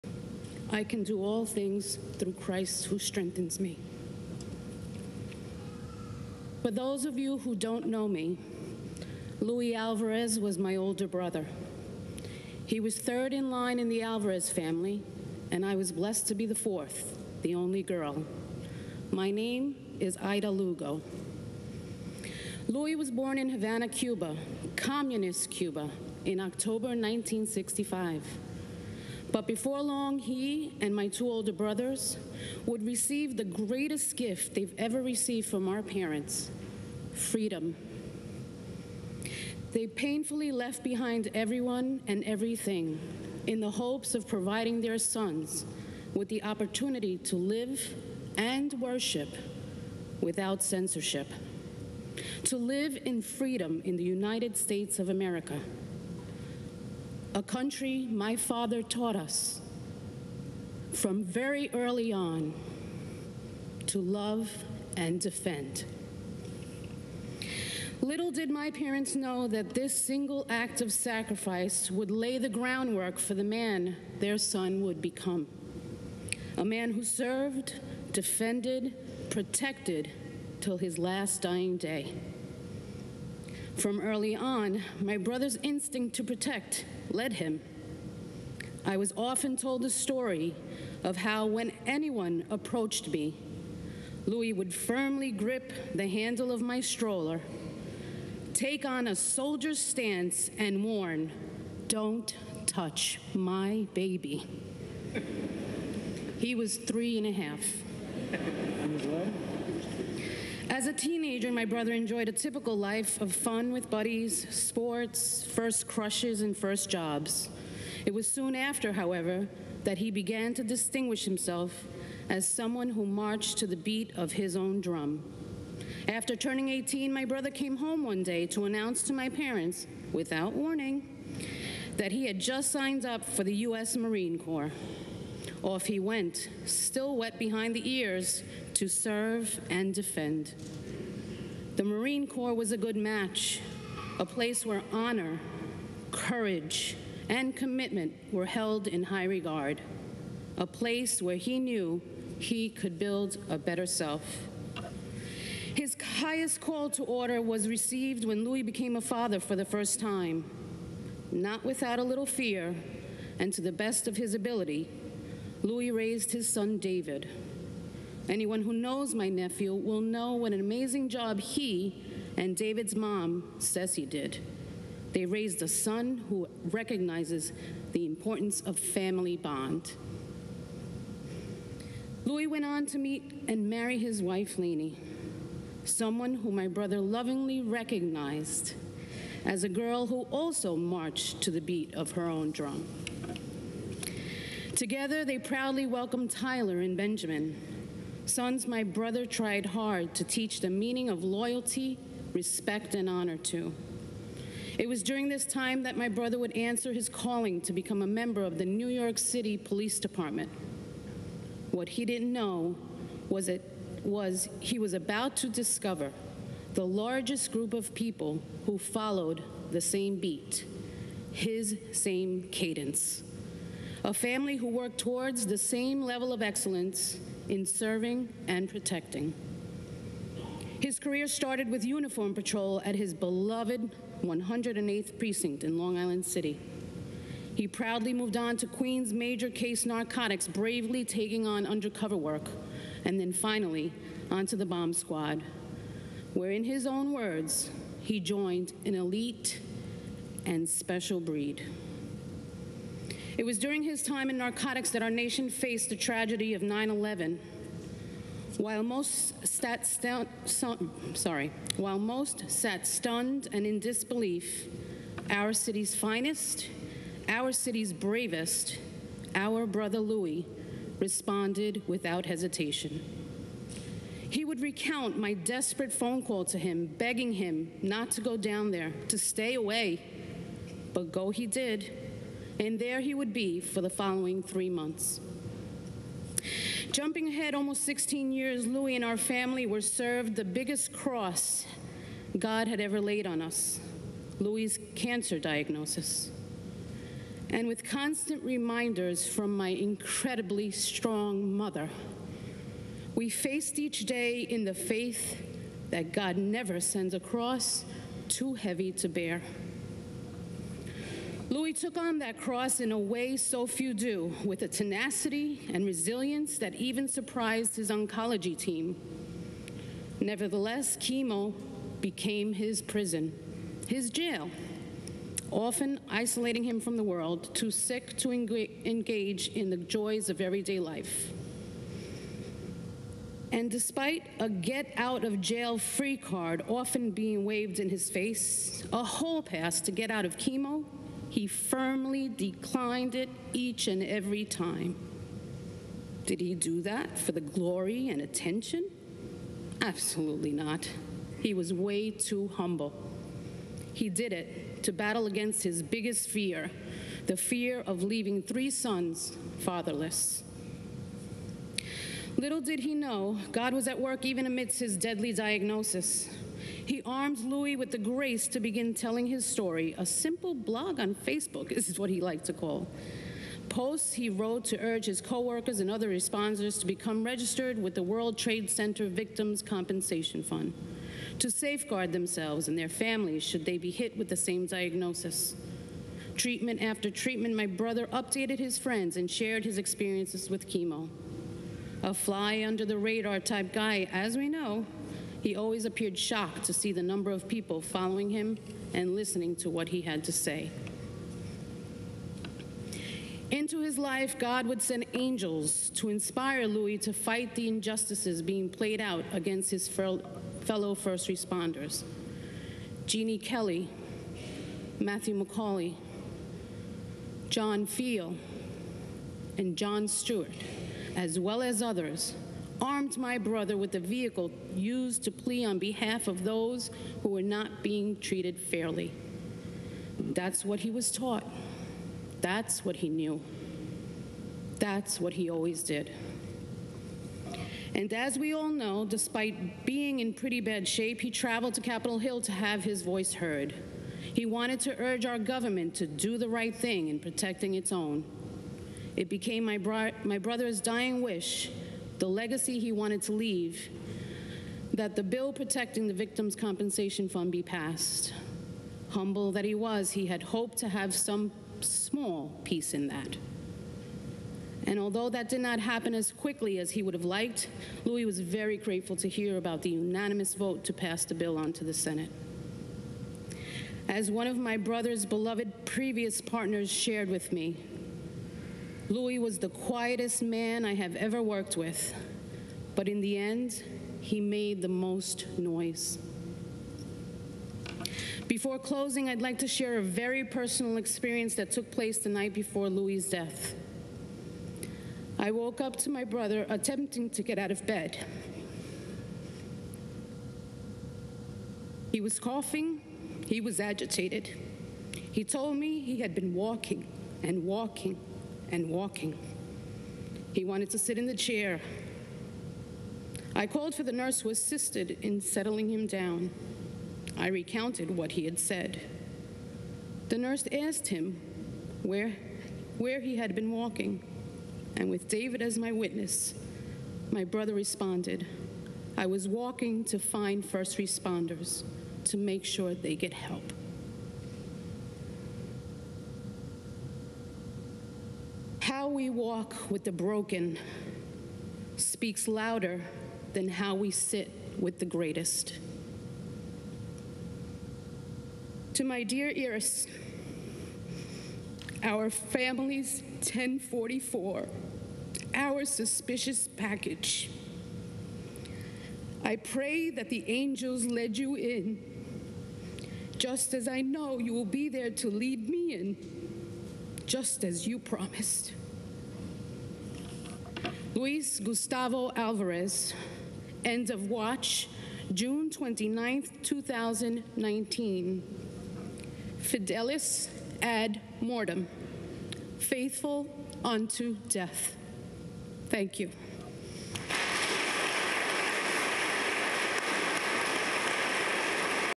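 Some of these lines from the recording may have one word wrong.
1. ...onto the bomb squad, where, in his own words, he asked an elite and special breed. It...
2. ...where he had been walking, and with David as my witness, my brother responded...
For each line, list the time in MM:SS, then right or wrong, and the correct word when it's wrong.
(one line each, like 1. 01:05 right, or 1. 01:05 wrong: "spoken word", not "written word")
1. 04:04 wrong: "joined", not "asked"
2. 08:42 right.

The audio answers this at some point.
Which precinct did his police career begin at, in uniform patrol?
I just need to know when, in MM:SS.
03:54.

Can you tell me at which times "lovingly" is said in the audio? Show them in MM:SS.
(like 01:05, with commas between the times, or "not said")
03:07.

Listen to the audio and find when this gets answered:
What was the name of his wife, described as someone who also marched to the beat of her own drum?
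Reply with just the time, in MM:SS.
03:04.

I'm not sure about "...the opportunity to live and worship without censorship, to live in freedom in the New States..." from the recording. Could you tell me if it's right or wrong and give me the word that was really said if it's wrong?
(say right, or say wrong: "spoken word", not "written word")
wrong: "United", not "New".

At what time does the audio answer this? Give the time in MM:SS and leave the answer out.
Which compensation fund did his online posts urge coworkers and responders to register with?
06:18.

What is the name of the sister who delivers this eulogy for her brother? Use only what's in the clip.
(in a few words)
Aida Lugo.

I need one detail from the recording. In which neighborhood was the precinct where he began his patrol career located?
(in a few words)
Long Island City.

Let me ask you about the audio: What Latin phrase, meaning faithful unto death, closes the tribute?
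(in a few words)
Fidelis ad mortem.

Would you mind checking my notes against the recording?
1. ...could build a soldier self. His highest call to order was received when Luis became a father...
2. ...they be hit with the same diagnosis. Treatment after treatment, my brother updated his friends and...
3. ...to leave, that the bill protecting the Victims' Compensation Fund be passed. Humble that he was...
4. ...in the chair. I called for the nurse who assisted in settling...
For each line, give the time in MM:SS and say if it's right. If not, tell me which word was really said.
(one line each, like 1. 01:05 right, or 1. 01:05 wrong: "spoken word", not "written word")
1. 02:32 wrong: "better", not "soldier"
2. 06:23 right
3. 07:33 right
4. 08:31 right.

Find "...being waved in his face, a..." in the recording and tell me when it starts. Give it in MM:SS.
05:37.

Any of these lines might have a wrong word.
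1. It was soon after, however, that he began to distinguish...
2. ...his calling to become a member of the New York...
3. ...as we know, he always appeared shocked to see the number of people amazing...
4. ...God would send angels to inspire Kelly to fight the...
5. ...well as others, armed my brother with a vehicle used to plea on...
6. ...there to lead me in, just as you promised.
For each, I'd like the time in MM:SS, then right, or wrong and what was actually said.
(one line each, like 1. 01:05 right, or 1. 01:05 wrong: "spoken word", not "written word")
1. 01:58 right
2. 03:26 right
3. 06:34 wrong: "following", not "amazing"
4. 06:44 wrong: "Luis", not "Kelly"
5. 07:01 right
6. 09:24 right.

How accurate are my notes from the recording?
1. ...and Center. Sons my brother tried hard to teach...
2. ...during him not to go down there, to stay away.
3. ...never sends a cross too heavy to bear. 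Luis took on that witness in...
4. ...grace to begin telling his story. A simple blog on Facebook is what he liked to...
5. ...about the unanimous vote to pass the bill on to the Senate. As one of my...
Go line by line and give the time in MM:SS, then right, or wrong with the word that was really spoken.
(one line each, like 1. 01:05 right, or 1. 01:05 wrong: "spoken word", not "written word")
1. 03:16 wrong: "Benjamin", not "Center"
2. 04:36 wrong: "begging", not "during"
3. 05:06 wrong: "cross", not "witness"
4. 06:07 right
5. 07:49 right.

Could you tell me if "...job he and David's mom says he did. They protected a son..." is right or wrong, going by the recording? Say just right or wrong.
wrong.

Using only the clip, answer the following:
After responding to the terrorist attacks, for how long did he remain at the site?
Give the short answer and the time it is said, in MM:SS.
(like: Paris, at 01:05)
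3 months, at 04:44.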